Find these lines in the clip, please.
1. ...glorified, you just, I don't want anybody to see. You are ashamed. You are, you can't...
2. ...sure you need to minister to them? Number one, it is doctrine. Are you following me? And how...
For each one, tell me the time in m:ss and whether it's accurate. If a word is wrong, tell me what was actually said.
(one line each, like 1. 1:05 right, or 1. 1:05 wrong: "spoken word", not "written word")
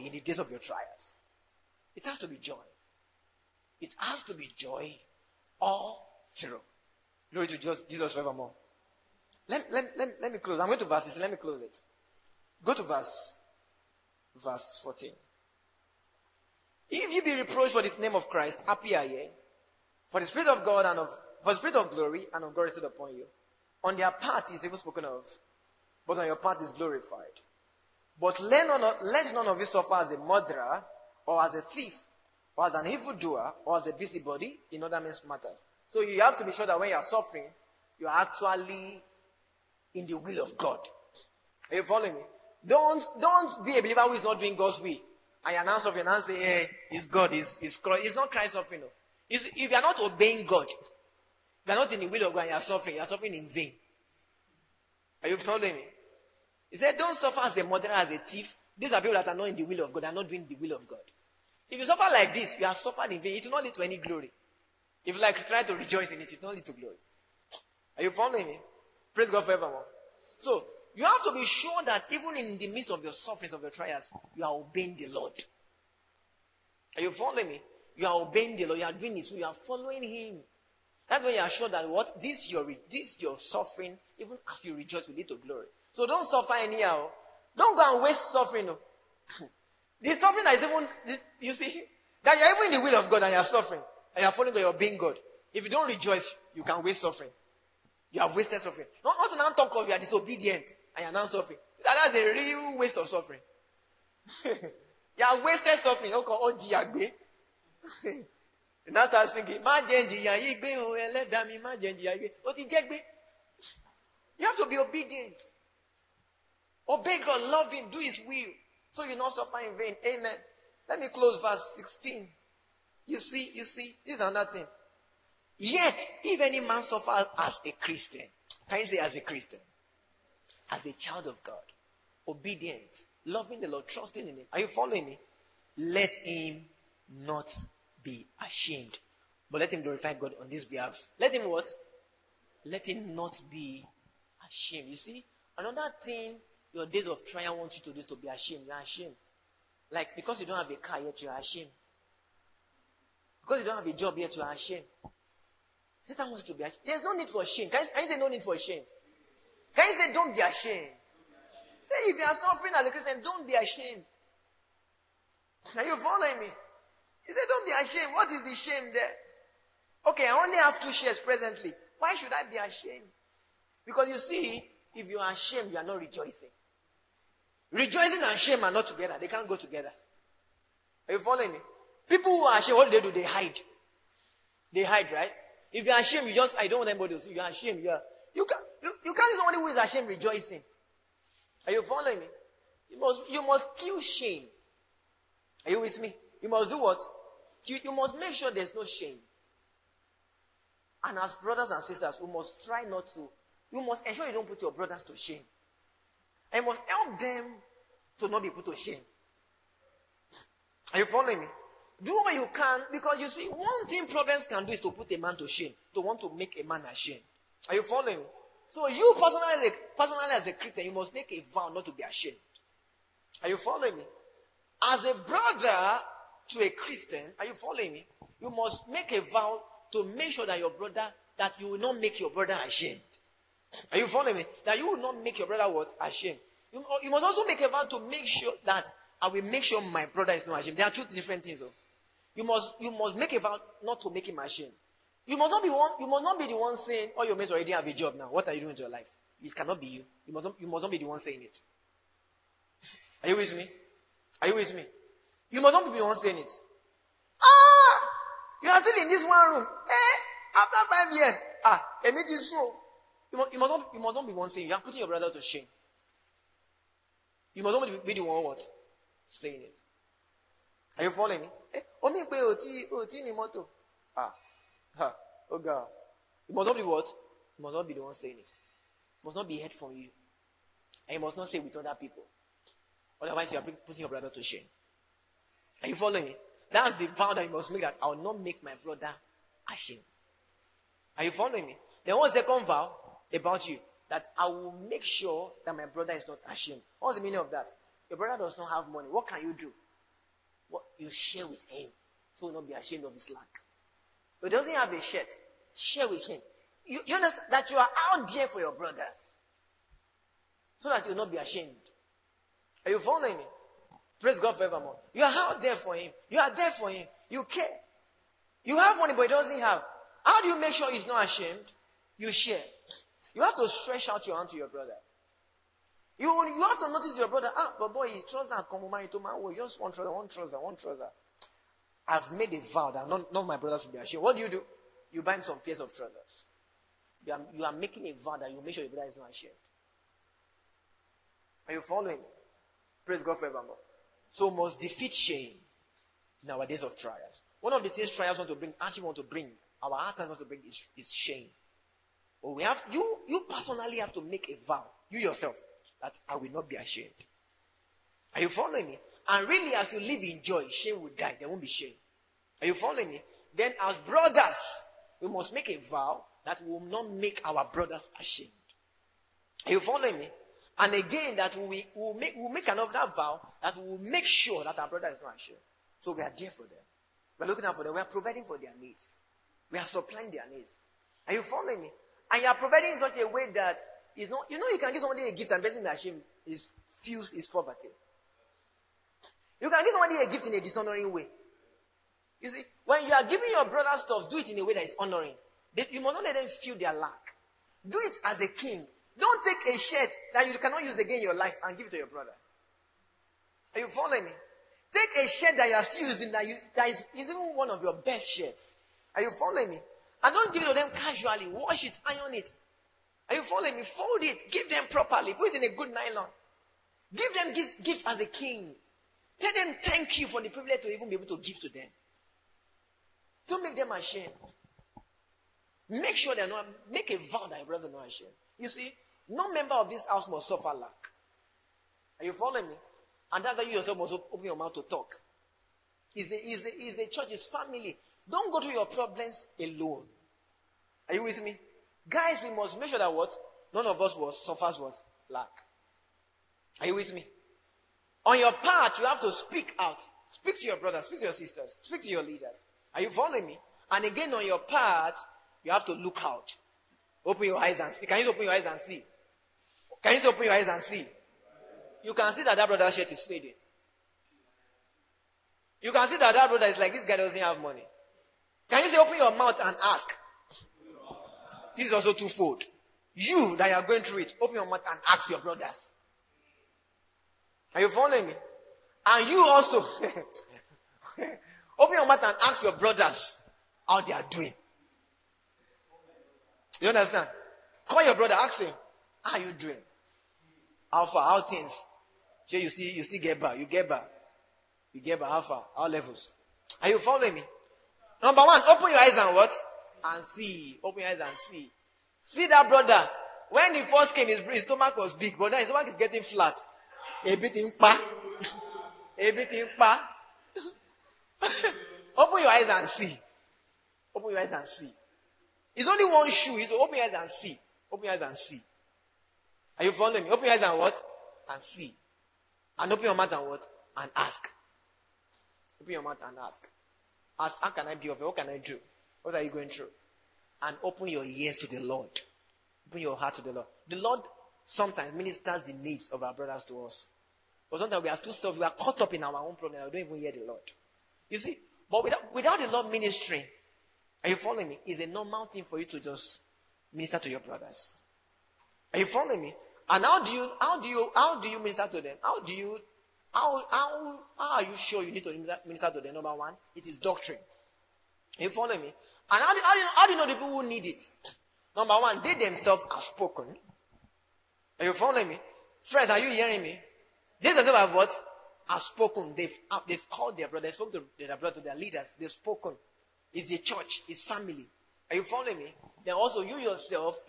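1. 3:06 wrong: "ashamed", not "glorified"
2. 9:14 right.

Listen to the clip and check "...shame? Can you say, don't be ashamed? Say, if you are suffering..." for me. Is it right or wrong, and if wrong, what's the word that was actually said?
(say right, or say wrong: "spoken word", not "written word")
right.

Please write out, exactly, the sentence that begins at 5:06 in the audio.
You, you understand that you are out there for your brothers.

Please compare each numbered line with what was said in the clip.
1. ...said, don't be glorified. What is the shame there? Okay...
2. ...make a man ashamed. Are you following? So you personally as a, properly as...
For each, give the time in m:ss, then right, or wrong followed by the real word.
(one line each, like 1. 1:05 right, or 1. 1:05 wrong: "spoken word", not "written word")
1. 2:47 wrong: "ashamed", not "glorified"
2. 3:36 wrong: "personally", not "properly".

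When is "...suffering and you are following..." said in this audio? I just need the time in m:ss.
1:33.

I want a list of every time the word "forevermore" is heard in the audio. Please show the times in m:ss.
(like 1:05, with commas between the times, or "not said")
0:08, 1:09, 5:14, 5:43.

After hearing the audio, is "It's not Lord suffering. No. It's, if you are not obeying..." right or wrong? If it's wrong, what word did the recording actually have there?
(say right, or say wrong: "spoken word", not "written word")
wrong: "Christ", not "Lord".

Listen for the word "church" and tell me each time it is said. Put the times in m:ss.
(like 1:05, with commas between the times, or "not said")
7:17, 9:33.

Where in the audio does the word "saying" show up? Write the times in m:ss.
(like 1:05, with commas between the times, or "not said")
4:06, 4:11, 4:16, 4:24, 4:29, 4:38.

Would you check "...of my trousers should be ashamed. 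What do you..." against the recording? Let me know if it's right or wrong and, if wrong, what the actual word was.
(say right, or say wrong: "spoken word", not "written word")
wrong: "brothers", not "trousers".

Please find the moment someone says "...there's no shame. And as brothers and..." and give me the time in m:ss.
3:18.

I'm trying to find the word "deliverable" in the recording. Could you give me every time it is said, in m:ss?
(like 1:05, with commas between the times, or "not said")
not said.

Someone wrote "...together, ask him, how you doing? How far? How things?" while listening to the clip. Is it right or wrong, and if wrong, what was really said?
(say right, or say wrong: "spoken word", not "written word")
wrong: "brother", not "together".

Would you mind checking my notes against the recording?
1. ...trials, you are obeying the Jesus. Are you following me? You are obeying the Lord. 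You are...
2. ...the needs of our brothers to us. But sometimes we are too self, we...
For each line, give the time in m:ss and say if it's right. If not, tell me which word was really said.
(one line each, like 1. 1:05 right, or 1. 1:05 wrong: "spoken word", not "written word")
1. 1:13 wrong: "Lord", not "Jesus"
2. 8:55 right.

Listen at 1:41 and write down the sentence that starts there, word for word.
That's a real waste of suffering.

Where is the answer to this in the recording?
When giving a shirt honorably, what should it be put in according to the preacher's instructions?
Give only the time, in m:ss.
6:55.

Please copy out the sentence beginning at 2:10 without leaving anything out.
as a child of God, obedient, loving the Lord, trusting in Him.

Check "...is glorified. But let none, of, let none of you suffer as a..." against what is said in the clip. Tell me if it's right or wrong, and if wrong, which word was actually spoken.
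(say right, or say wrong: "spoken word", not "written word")
right.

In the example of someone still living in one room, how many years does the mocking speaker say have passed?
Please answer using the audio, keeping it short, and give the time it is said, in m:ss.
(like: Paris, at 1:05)
5, at 4:20.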